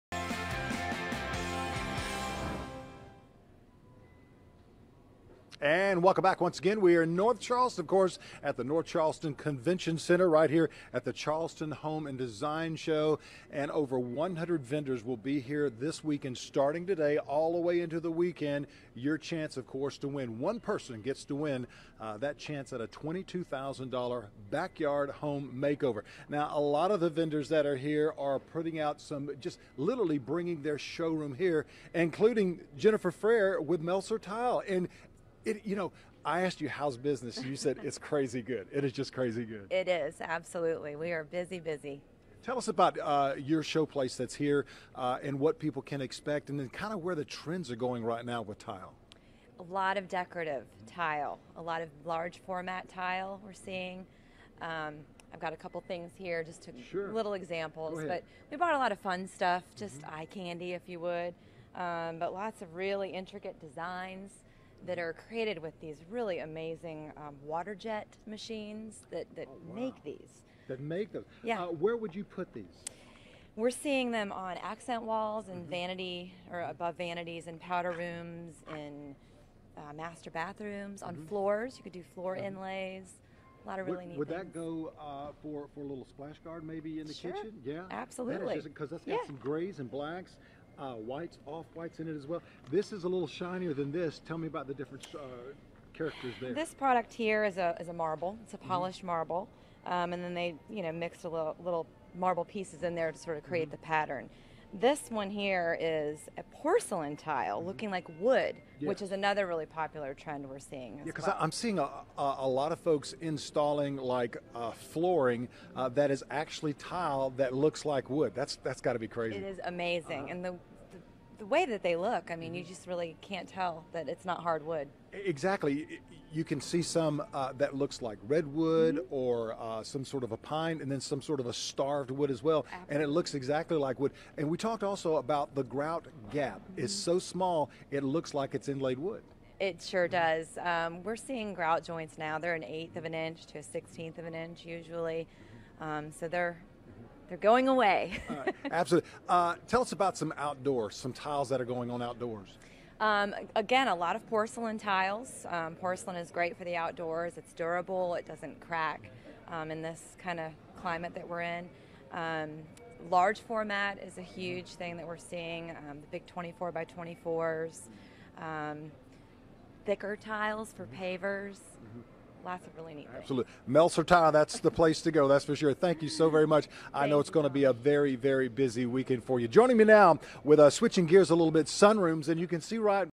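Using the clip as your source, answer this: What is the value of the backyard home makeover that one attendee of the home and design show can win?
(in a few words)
$22,000.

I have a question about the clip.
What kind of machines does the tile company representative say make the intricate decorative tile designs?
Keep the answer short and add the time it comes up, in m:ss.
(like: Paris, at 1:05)
Water jet machines, at 1:07.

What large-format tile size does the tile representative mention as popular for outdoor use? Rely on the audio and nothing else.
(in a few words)
24 by 24.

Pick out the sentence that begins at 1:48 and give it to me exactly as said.
which is another really popular trend we're seeing.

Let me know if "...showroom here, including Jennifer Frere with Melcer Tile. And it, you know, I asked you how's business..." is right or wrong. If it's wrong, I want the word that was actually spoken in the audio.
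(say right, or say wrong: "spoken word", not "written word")
right.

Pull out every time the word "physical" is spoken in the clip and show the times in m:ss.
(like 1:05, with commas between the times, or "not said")
not said.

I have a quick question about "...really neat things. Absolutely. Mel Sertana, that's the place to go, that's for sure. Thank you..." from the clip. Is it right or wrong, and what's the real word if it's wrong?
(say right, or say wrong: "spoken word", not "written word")
right.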